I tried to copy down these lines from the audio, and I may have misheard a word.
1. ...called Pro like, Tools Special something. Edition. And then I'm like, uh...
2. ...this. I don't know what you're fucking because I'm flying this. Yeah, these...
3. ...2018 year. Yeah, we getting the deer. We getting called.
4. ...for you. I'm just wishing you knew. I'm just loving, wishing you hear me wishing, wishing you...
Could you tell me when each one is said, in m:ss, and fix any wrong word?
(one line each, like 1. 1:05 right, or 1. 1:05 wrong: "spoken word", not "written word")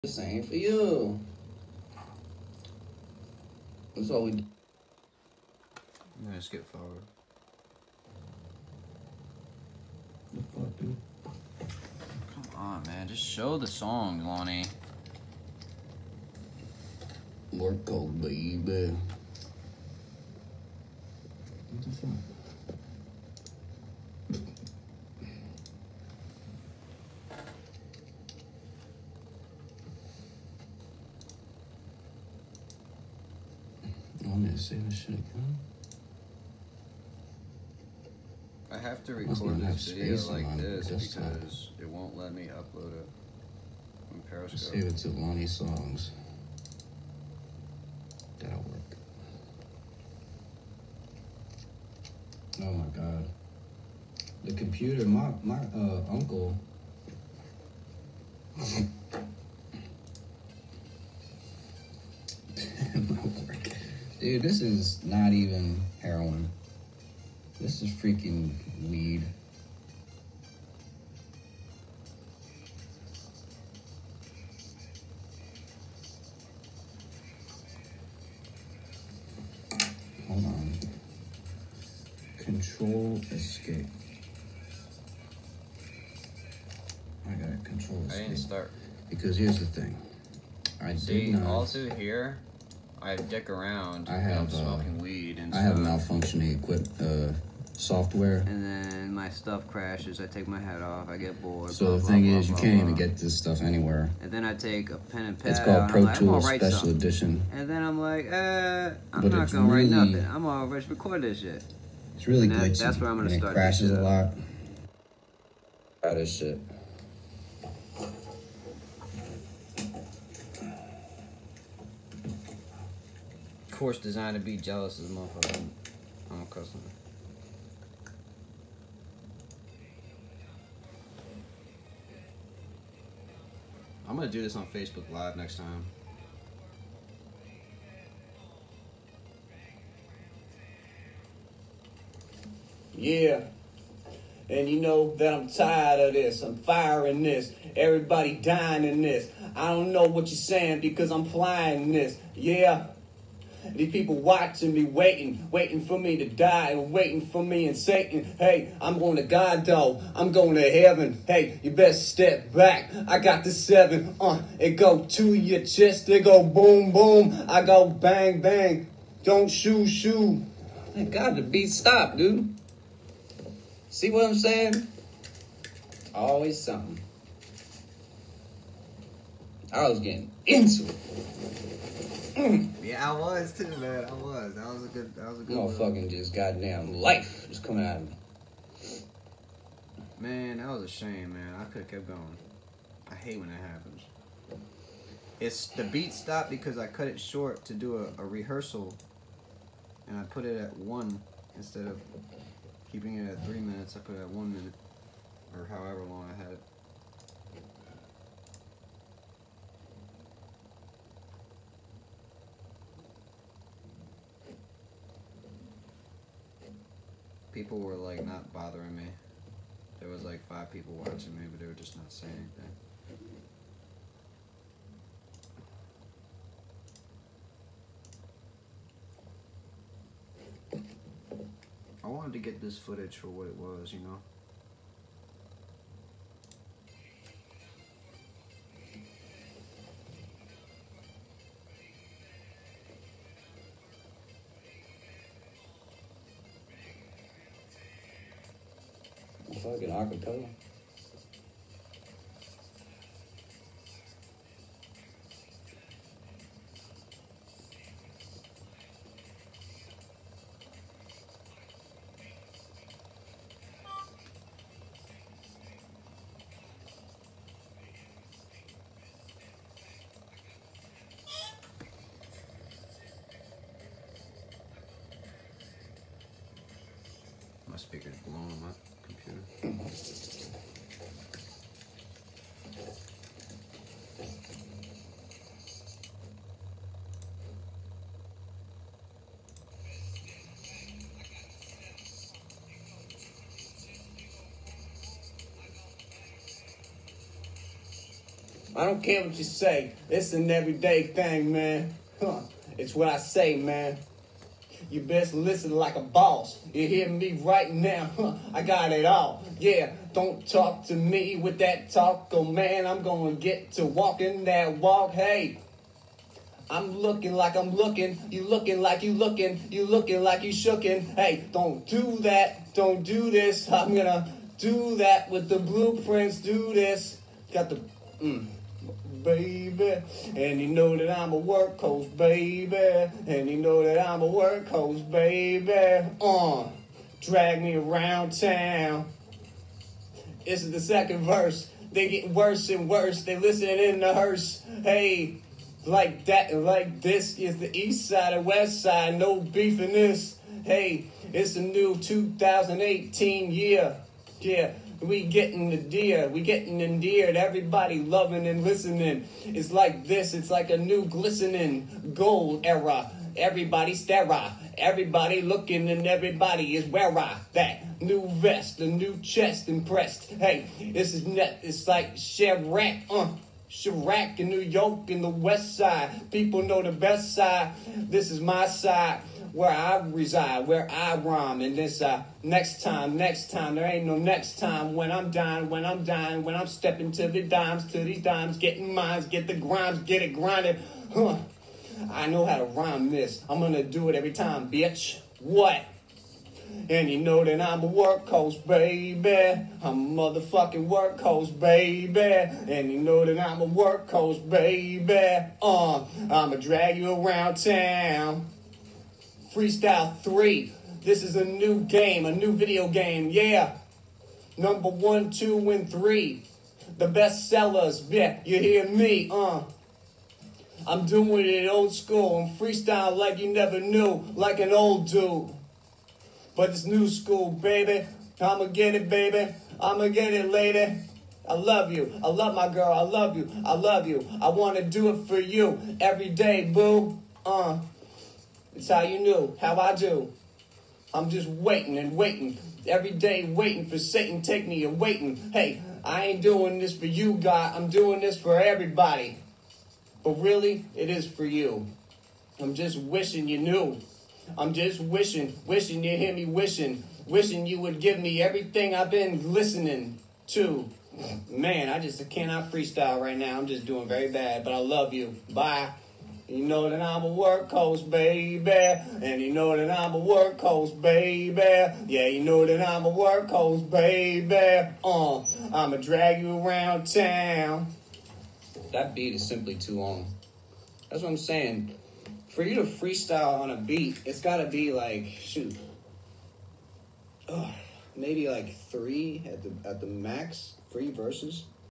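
1. 1:45 right
2. 2:29 wrong: "saying", not "fucking"
3. 5:51 wrong: "endeared", not "called"
4. 7:31 wrong: "wishing", not "loving".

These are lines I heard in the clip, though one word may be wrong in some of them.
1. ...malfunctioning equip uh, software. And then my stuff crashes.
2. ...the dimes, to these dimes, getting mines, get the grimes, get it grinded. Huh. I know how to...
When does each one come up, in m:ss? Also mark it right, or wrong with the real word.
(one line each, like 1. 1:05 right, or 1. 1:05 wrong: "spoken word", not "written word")
1. 1:35 right
2. 6:27 right.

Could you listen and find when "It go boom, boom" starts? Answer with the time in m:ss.
2:46.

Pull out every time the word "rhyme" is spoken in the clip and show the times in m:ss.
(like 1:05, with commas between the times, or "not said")
6:21, 6:32.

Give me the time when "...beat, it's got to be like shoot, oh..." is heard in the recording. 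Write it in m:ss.
8:03.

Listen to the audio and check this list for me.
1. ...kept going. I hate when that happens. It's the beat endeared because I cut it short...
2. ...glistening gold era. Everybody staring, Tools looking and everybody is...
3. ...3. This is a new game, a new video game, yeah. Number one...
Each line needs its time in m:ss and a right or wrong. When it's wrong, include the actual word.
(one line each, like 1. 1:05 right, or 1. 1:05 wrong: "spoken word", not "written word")
1. 3:11 wrong: "stopped", not "endeared"
2. 6:01 wrong: "Everybody", not "Tools"
3. 6:50 right.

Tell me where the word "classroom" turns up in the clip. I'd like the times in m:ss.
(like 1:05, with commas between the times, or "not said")
not said.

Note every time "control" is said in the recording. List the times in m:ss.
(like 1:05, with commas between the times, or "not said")
1:22, 1:27.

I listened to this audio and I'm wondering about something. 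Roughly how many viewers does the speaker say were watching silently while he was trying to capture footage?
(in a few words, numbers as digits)
5.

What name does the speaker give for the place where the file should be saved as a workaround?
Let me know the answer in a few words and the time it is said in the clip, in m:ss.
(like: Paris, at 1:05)
Lonny Songs, at 0:45.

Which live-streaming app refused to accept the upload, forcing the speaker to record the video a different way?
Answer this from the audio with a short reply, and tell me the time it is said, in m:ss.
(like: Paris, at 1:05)
Periscope, at 0:44.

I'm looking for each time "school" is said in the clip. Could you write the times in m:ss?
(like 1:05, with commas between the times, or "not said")
7:01, 7:07.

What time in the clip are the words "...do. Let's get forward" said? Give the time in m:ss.
0:04.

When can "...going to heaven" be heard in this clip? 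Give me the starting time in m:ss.
2:40.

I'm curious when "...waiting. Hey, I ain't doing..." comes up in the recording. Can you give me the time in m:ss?
7:24.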